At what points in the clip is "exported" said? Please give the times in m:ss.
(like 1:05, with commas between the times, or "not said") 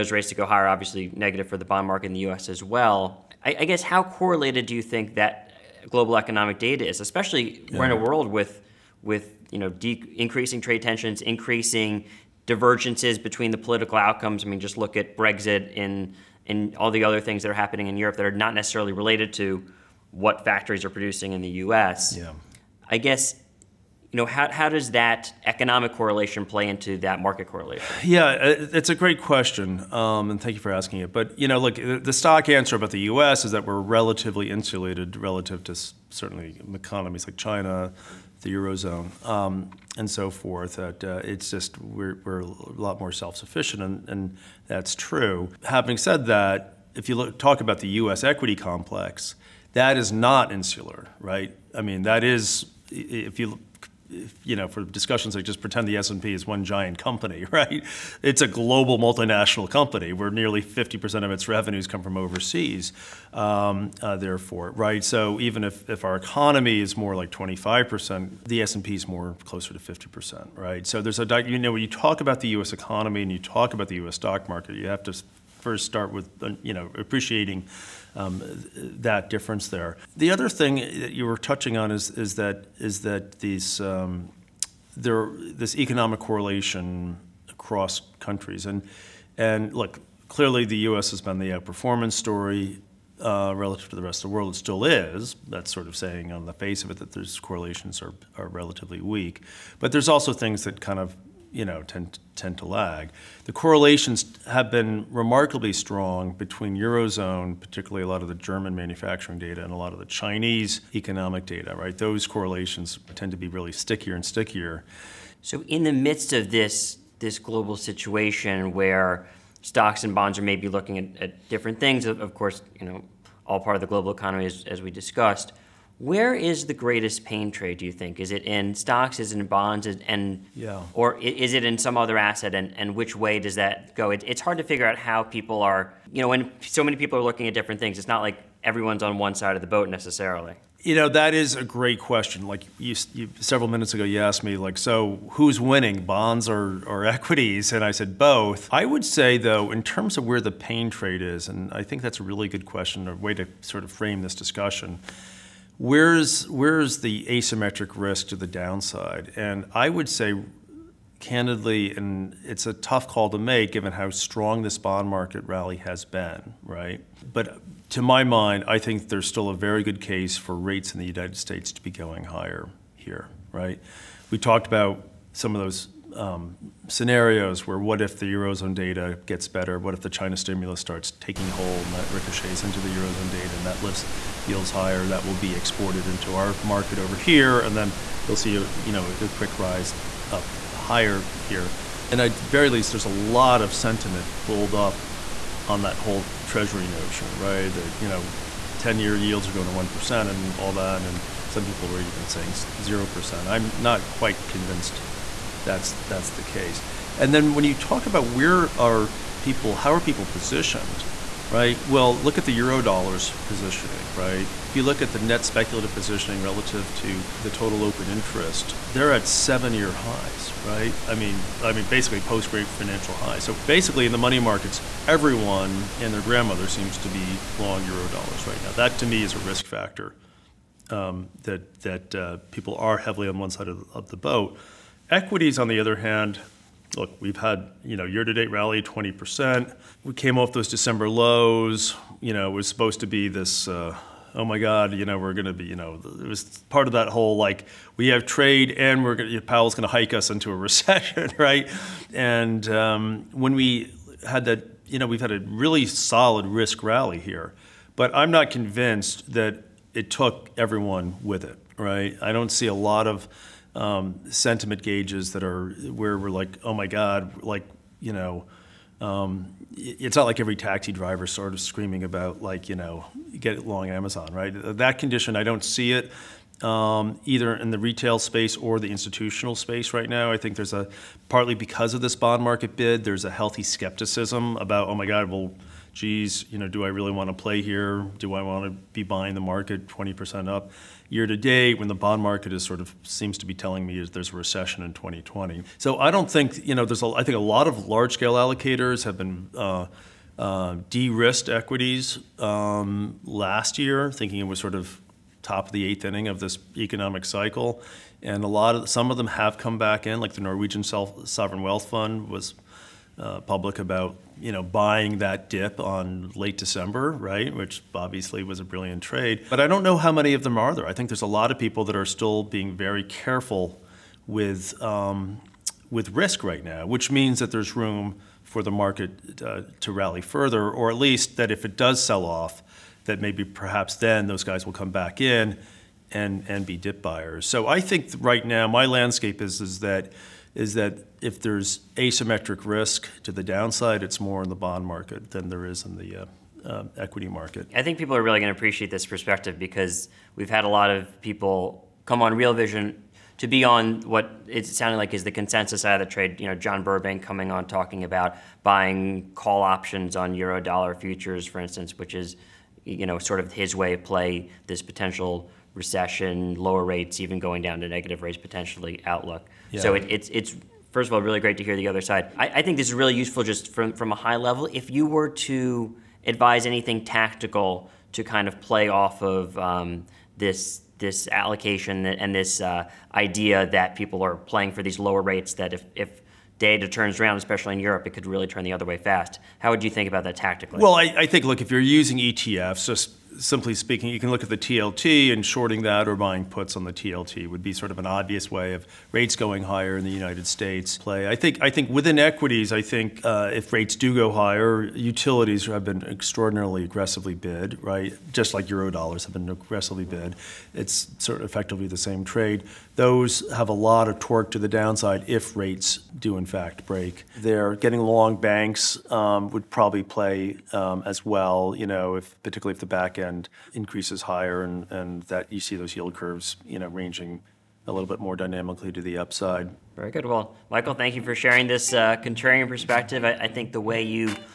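3:05.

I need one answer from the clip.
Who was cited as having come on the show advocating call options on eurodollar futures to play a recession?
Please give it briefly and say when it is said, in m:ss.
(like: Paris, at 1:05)
John Burbank, at 5:56.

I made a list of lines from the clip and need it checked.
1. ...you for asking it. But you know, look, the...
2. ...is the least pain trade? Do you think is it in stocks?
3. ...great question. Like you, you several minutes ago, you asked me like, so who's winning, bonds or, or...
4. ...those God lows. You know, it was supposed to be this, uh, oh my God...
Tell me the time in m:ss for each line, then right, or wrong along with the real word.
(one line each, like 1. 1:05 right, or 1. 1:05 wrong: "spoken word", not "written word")
1. 0:30 right
2. 2:06 wrong: "greatest", not "least"
3. 2:21 right
4. 4:00 wrong: "December", not "God".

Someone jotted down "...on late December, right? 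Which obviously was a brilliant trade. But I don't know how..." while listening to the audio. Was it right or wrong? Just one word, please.
right.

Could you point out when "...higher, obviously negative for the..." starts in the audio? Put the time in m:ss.
0:00.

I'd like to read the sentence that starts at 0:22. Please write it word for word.
I guess you know, how, how does that economic correlation play into that market correlation?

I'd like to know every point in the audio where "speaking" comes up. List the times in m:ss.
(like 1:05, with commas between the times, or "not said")
6:33.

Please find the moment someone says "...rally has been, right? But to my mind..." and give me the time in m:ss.
2:45.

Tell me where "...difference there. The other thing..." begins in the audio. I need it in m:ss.
1:19.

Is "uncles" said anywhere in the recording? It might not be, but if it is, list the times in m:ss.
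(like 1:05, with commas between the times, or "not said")
not said.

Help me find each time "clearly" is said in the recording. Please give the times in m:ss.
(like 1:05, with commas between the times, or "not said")
1:30.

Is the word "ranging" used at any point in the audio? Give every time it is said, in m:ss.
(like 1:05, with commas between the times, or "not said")
7:06.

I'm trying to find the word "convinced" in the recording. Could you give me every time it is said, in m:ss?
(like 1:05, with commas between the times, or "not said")
3:24, 4:18.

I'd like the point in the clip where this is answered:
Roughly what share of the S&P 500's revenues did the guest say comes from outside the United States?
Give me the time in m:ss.
1:00.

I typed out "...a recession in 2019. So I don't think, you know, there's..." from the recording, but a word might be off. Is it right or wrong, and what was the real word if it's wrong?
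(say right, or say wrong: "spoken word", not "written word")
wrong: "2020", not "2019".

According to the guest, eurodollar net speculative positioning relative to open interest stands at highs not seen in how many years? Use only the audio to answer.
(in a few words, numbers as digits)
7.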